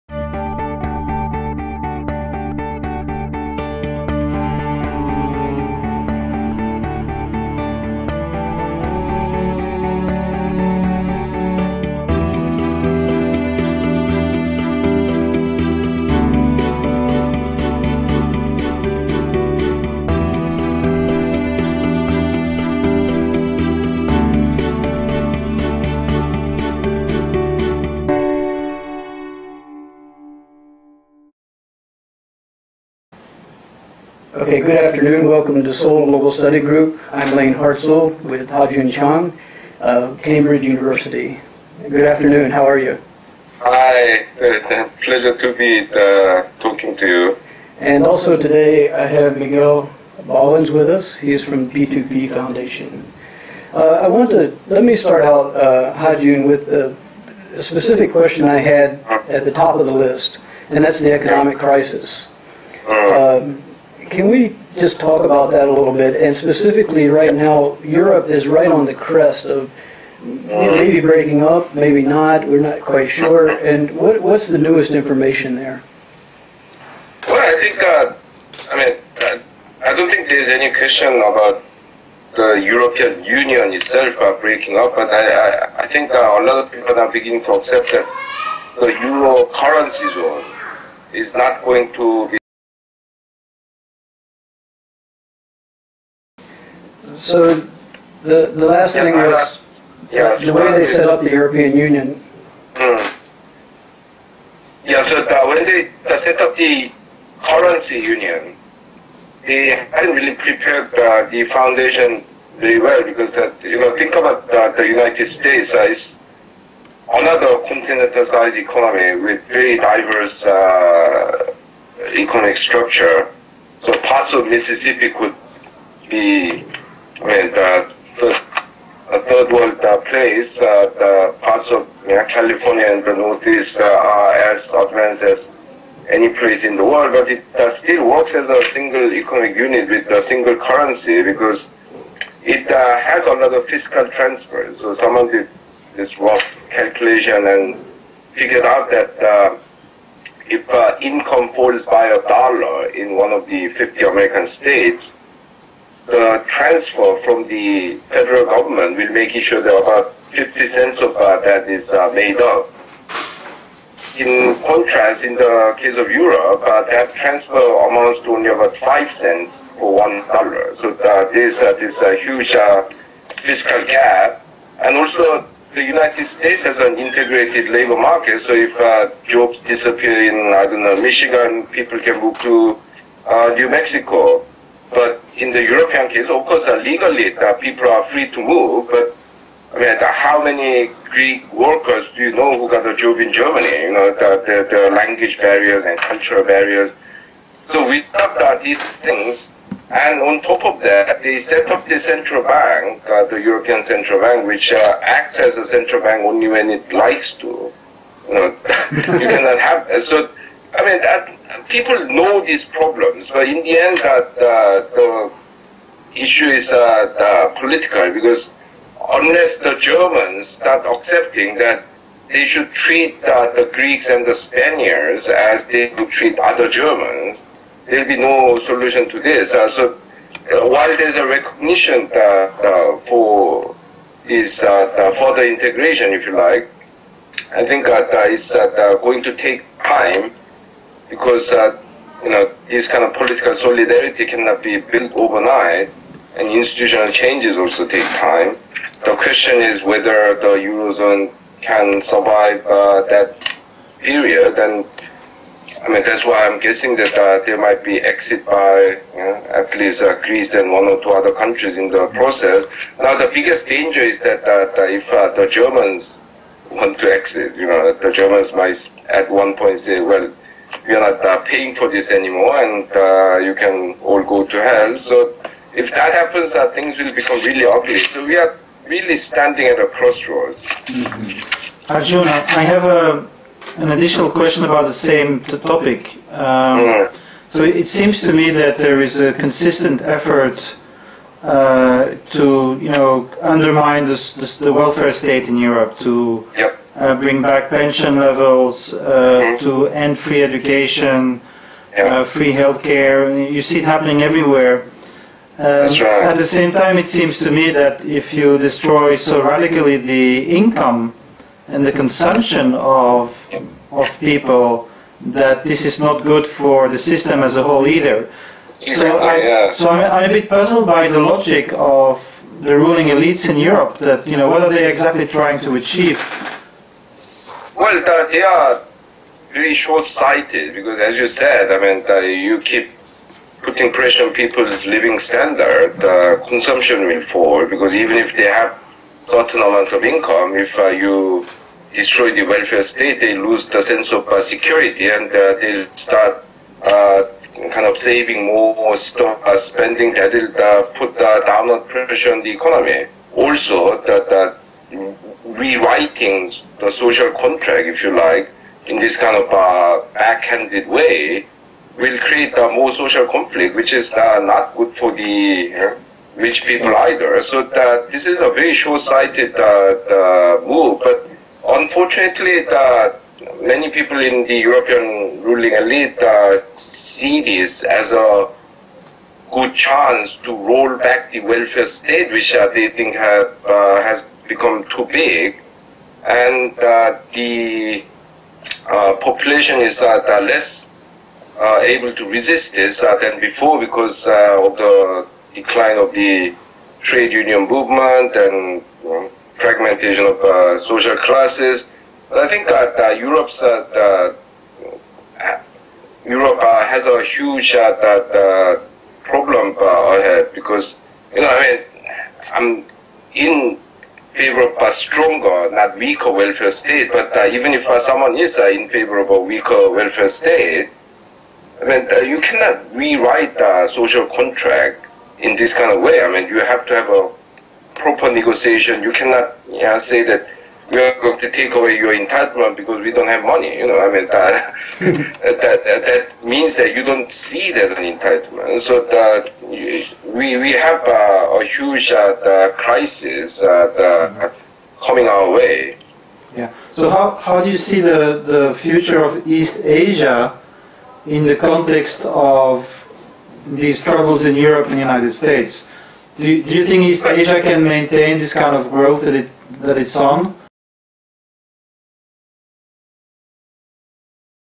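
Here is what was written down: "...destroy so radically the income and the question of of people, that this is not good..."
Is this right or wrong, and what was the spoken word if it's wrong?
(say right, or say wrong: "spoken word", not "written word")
wrong: "consumption", not "question".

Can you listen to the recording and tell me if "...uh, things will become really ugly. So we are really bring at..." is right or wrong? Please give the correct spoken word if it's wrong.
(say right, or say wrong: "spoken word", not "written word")
wrong: "standing", not "bring".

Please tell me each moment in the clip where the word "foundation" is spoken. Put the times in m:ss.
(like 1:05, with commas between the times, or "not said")
0:52, 1:51.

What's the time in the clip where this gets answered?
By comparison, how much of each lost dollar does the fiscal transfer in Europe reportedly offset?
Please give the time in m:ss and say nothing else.
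2:48.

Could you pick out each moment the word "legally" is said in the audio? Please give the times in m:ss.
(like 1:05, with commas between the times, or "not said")
3:06.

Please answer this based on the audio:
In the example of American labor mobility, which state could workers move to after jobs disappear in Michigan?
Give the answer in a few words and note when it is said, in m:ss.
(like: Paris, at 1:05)
New Mexico, at 3:03.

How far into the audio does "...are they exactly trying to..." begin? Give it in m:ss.
5:24.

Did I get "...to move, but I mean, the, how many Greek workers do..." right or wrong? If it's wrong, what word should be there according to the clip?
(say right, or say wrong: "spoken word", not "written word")
right.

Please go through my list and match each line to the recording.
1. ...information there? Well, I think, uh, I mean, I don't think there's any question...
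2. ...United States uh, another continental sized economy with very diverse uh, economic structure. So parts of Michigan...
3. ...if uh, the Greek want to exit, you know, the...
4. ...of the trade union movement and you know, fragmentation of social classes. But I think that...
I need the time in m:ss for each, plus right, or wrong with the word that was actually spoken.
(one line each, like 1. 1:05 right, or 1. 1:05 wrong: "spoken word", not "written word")
1. 1:14 right
2. 1:54 wrong: "Mississippi", not "Michigan"
3. 4:24 wrong: "Germans", not "Greek"
4. 6:35 right.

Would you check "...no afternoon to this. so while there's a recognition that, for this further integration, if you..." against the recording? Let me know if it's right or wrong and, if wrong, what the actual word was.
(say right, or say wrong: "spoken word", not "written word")
wrong: "solution", not "afternoon".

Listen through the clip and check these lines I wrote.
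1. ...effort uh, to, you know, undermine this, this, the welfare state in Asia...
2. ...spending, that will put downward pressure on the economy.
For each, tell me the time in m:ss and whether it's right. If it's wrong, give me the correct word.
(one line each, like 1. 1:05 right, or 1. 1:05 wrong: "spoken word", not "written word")
1. 4:50 wrong: "Europe", not "Asia"
2. 5:49 right.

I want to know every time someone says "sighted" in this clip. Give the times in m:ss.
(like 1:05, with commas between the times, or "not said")
5:29, 6:08.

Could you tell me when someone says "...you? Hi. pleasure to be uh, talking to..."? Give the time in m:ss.
0:42.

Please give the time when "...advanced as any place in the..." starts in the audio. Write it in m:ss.
2:14.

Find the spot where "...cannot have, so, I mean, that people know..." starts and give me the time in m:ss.
3:29.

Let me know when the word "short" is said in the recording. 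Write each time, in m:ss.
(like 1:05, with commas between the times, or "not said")
5:29, 6:08.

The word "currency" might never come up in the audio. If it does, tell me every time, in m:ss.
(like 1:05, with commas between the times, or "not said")
1:29, 1:47, 2:20.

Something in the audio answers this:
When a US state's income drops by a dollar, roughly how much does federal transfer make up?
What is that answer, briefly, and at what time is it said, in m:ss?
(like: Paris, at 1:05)
50 cents, at 2:40.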